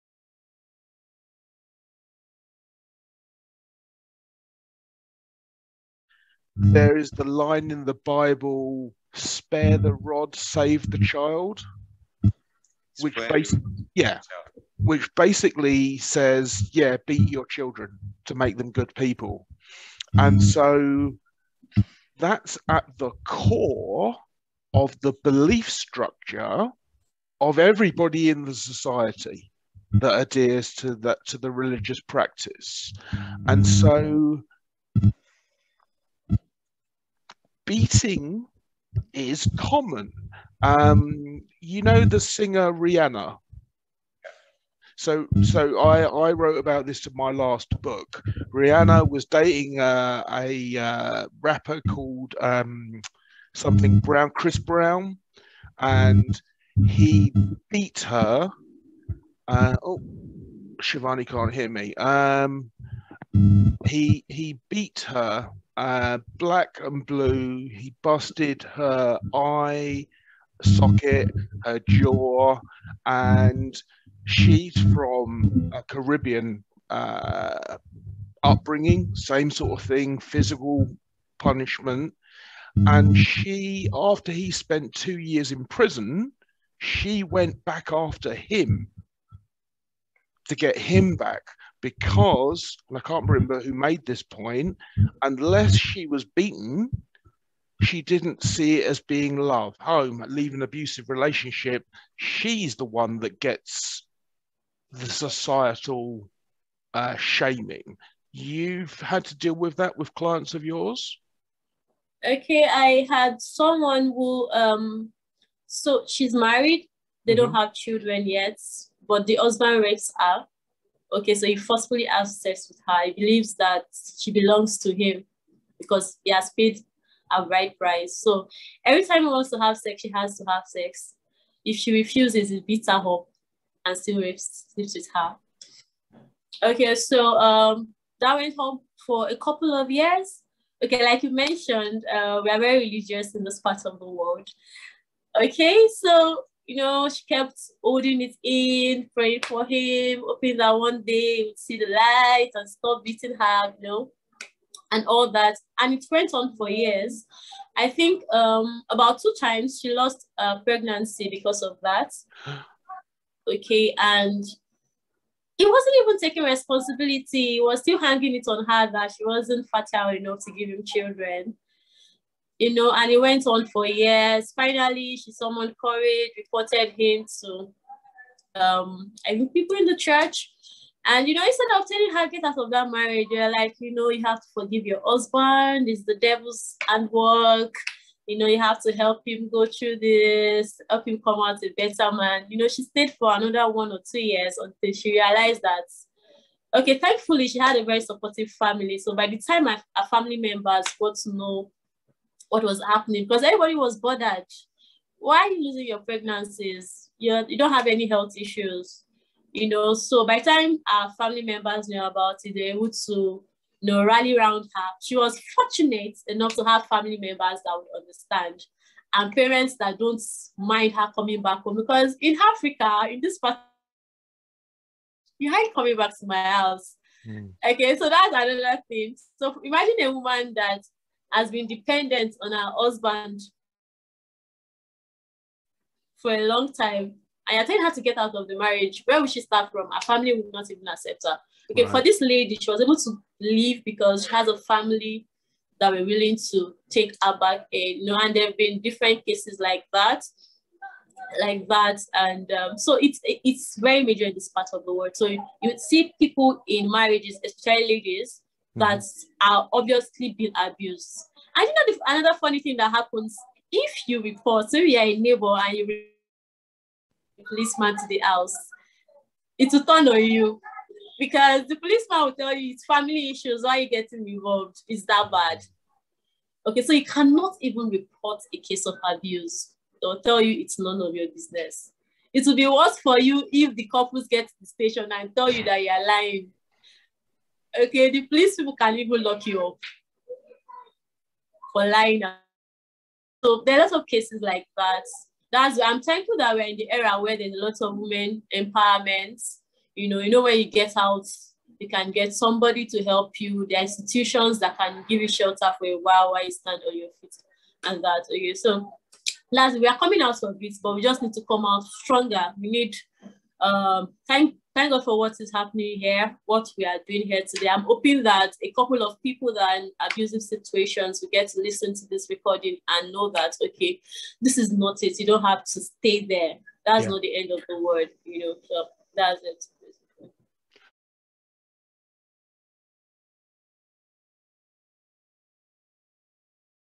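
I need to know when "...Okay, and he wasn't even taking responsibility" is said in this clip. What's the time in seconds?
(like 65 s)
163 s.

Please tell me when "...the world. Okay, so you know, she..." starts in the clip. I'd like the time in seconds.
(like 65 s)
143 s.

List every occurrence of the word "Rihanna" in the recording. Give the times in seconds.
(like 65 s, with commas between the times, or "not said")
42 s, 48 s.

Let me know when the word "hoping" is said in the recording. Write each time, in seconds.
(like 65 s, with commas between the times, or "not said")
150 s, 317 s.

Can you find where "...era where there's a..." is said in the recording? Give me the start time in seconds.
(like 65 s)
296 s.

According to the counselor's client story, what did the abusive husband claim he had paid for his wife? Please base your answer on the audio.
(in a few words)
right price.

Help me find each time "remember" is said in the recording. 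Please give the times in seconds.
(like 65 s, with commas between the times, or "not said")
93 s.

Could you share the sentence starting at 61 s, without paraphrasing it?
Um, he he beat her uh, black and blue.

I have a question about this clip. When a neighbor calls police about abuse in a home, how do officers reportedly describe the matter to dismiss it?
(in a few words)
family issues.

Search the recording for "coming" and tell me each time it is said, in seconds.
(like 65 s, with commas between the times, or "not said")
221 s, 225 s, 309 s.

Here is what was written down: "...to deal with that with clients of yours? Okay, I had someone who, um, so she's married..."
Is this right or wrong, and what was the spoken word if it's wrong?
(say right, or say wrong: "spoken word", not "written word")
right.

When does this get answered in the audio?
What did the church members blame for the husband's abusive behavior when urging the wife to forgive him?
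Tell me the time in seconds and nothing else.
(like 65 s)
186 s.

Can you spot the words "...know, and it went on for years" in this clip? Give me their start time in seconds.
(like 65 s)
172 s.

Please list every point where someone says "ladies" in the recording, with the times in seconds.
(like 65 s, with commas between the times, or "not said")
257 s.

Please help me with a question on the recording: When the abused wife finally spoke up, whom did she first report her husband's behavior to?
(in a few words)
people in the church.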